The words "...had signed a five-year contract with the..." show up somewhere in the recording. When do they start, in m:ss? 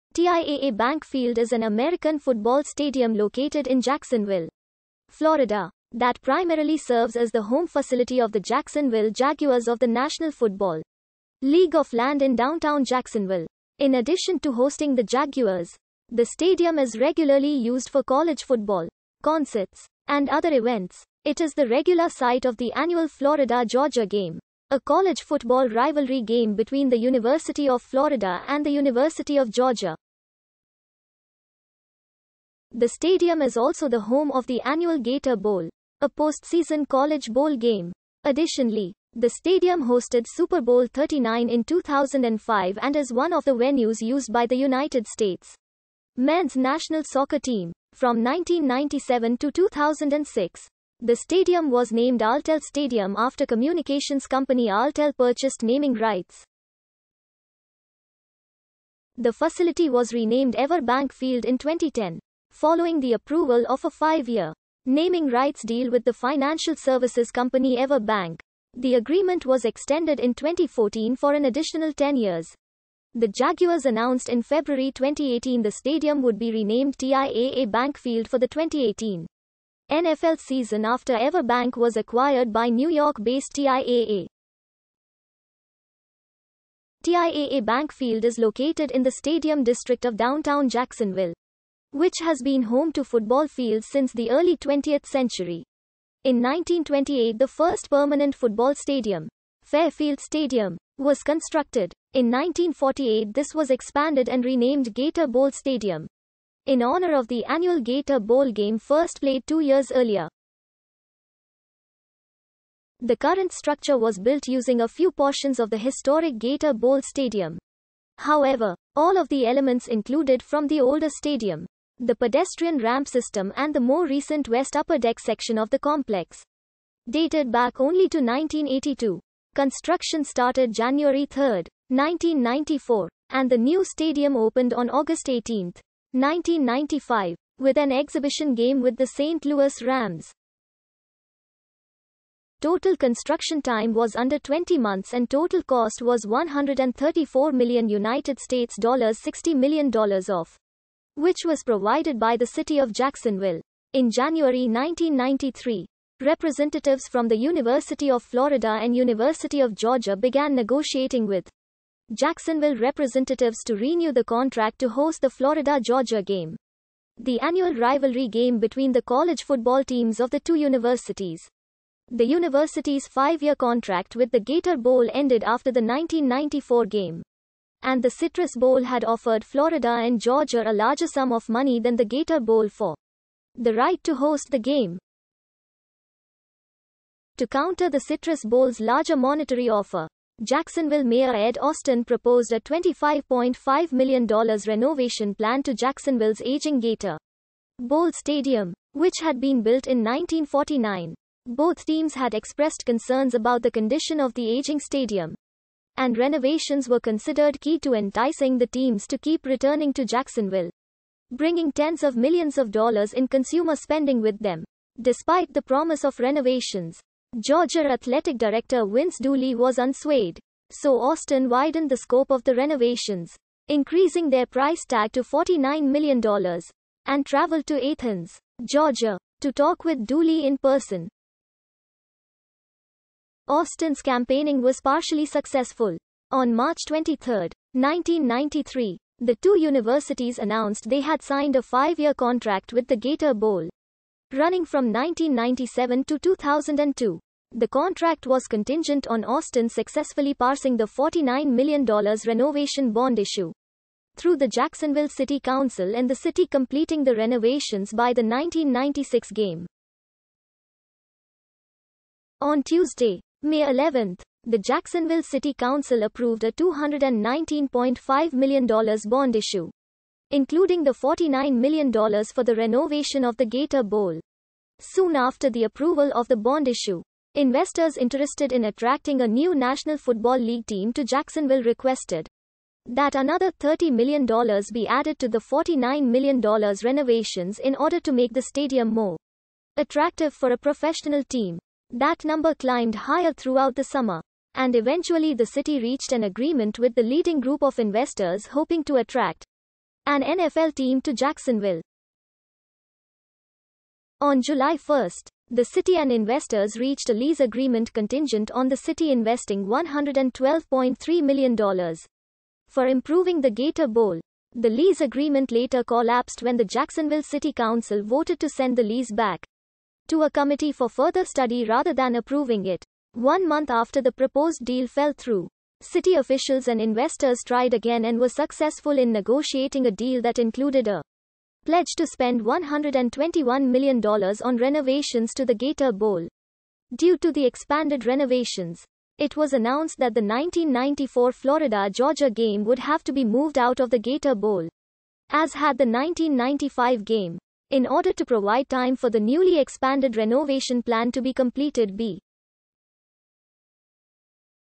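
4:01.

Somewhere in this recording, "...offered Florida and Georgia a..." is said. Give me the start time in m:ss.
2:59.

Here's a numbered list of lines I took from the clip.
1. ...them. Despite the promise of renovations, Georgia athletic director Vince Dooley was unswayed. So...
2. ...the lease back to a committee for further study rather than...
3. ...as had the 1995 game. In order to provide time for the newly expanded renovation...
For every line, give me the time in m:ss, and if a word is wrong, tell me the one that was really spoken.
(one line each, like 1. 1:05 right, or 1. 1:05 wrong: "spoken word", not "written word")
1. 3:34 right
2. 5:18 right
3. 5:45 right.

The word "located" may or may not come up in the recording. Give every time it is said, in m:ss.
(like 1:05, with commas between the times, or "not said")
0:03, 1:28.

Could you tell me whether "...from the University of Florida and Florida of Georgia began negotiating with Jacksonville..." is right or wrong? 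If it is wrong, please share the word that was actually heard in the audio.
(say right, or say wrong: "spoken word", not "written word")
wrong: "University", not "Florida".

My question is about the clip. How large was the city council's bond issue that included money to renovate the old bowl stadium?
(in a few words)
$219.5 million.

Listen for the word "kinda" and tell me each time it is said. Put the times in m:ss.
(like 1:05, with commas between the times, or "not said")
not said.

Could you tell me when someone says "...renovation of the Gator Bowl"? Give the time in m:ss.
4:32.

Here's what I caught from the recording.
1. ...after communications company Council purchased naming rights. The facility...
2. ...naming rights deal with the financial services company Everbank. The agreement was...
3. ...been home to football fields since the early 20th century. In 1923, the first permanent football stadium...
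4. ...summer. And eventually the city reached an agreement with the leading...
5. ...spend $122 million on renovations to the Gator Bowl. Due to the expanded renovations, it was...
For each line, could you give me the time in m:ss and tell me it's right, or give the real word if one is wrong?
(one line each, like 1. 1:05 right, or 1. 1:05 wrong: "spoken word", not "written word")
1. 0:53 wrong: "Alltel", not "Council"
2. 1:04 right
3. 1:32 wrong: "1928", not "1923"
4. 4:53 right
5. 5:32 wrong: "121", not "122".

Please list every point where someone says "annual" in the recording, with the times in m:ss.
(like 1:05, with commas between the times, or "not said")
0:22, 0:34, 1:47, 2:47.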